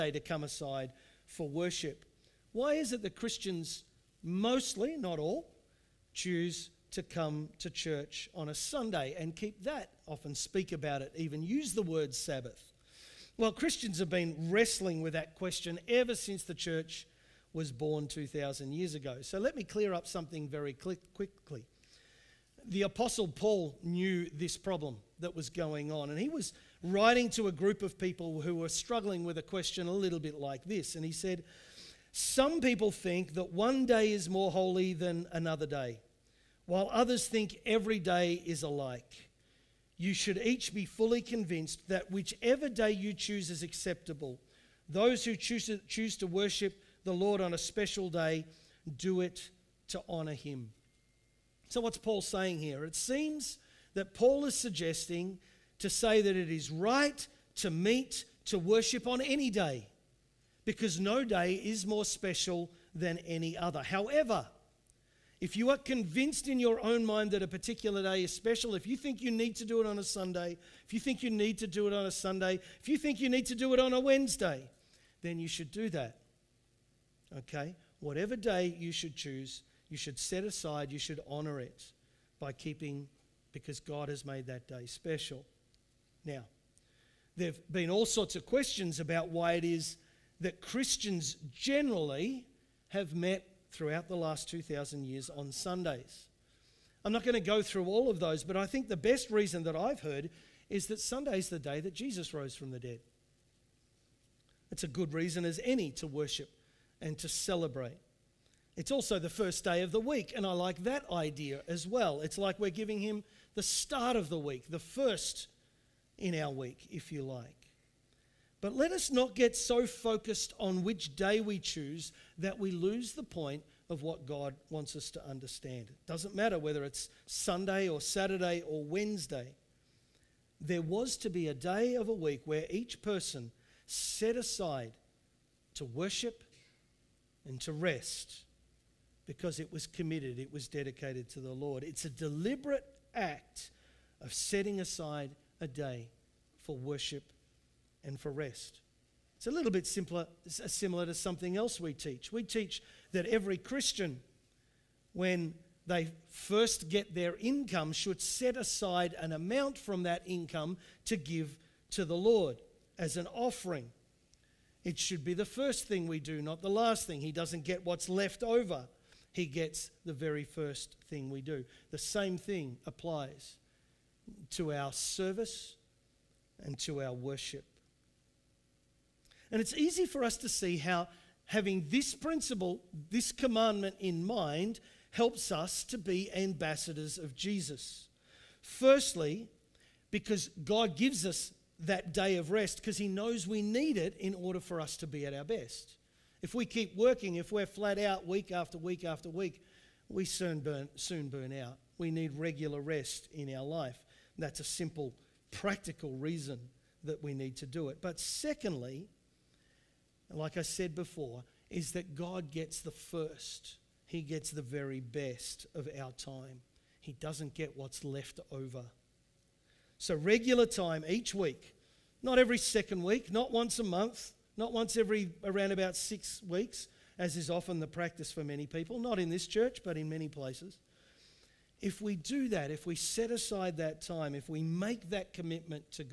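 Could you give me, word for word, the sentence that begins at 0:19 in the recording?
So let me clear up something very quickly.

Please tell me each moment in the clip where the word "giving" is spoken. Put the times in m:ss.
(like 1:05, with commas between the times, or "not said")
1:52.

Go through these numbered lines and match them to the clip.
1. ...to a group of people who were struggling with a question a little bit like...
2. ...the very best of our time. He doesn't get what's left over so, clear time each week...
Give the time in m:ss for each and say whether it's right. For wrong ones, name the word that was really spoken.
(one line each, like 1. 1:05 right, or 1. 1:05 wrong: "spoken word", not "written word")
1. 0:27 right
2. 3:34 wrong: "regular", not "clear".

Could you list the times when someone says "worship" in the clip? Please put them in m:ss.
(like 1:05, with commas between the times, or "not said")
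0:01, 0:46, 0:58, 1:46, 2:15, 2:26, 2:57.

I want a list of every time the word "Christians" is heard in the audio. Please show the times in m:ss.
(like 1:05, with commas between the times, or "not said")
0:03, 0:13, 1:30, 2:33.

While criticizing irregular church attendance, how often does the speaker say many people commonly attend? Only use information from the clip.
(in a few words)
every 6 weeks.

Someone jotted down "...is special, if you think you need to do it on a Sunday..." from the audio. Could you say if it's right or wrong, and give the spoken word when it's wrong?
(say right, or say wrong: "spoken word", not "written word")
right.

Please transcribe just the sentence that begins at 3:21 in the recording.
We need regular rest in our life.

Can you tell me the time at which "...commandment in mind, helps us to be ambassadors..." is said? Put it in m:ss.
3:03.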